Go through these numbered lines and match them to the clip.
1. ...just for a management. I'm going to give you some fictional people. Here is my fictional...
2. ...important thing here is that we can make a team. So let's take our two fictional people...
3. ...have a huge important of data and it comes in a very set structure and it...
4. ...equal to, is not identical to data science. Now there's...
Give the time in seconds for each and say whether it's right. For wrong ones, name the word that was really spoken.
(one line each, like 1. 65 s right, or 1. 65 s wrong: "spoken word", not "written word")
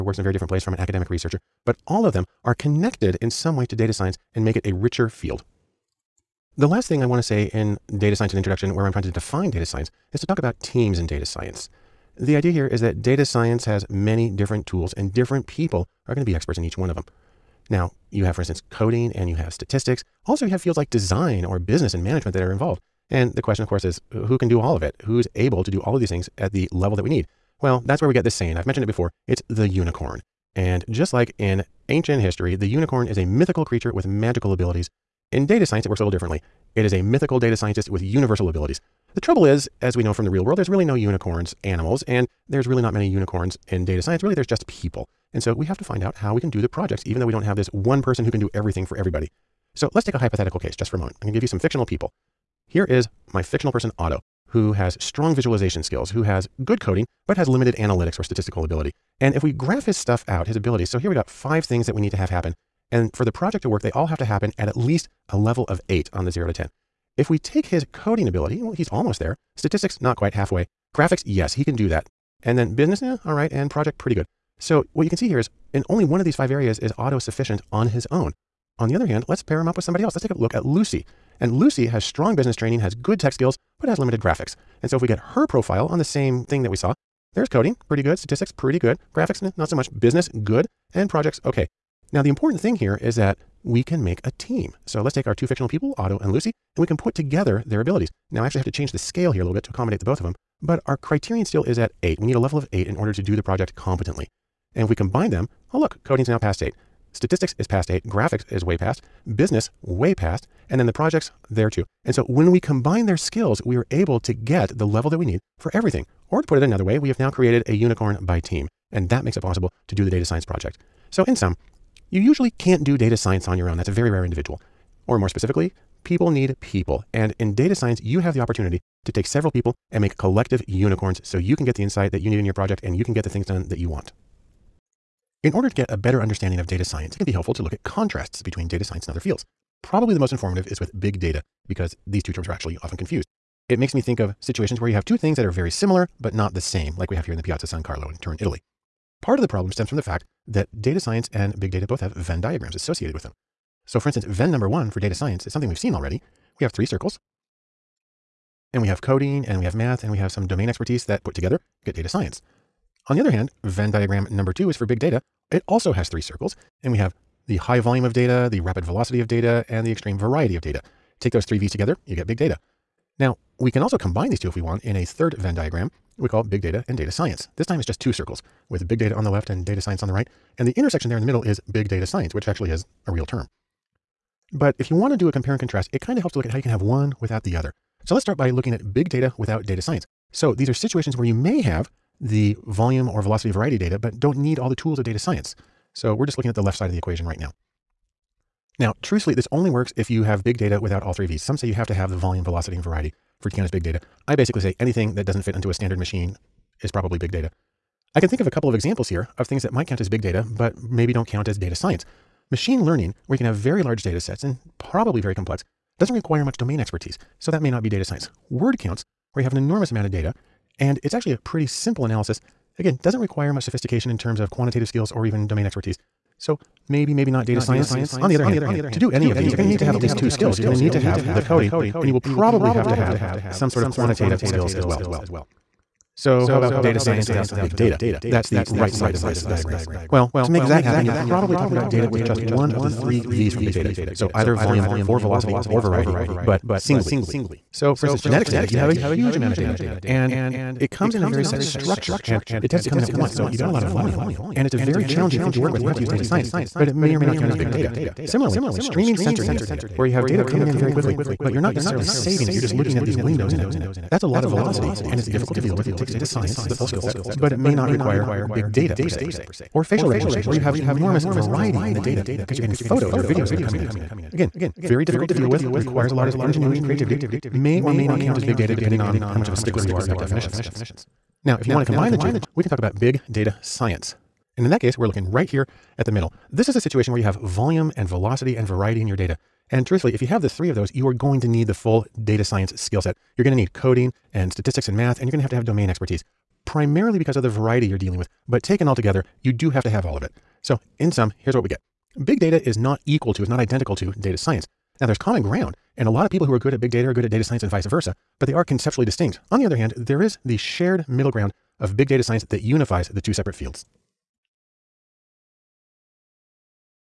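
1. 50 s wrong: "moment", not "management"
2. 92 s right
3. 248 s wrong: "amount", not "important"
4. 303 s right.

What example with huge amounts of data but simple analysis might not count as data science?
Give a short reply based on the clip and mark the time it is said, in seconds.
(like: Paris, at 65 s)
Word counts, at 218 s.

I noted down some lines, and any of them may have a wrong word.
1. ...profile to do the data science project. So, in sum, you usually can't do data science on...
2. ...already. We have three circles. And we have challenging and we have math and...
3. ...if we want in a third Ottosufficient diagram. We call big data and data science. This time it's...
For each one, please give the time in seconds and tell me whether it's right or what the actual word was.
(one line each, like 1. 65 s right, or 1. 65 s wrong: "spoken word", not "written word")
1. 119 s wrong: "possible", not "profile"
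2. 155 s wrong: "coding", not "challenging"
3. 174 s wrong: "Venn", not "Ottosufficient".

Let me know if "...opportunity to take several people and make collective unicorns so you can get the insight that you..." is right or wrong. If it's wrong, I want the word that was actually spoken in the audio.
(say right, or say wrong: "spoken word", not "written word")
right.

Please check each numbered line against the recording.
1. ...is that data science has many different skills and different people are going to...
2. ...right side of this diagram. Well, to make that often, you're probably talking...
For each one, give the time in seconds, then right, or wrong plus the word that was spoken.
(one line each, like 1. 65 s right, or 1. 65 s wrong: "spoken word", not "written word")
1. 12 s wrong: "tools", not "skills"
2. 238 s wrong: "happen", not "often".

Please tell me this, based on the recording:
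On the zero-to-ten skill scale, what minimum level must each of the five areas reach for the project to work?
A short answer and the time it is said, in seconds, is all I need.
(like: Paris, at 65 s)
8, at 65 s.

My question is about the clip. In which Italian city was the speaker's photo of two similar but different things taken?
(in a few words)
Turin.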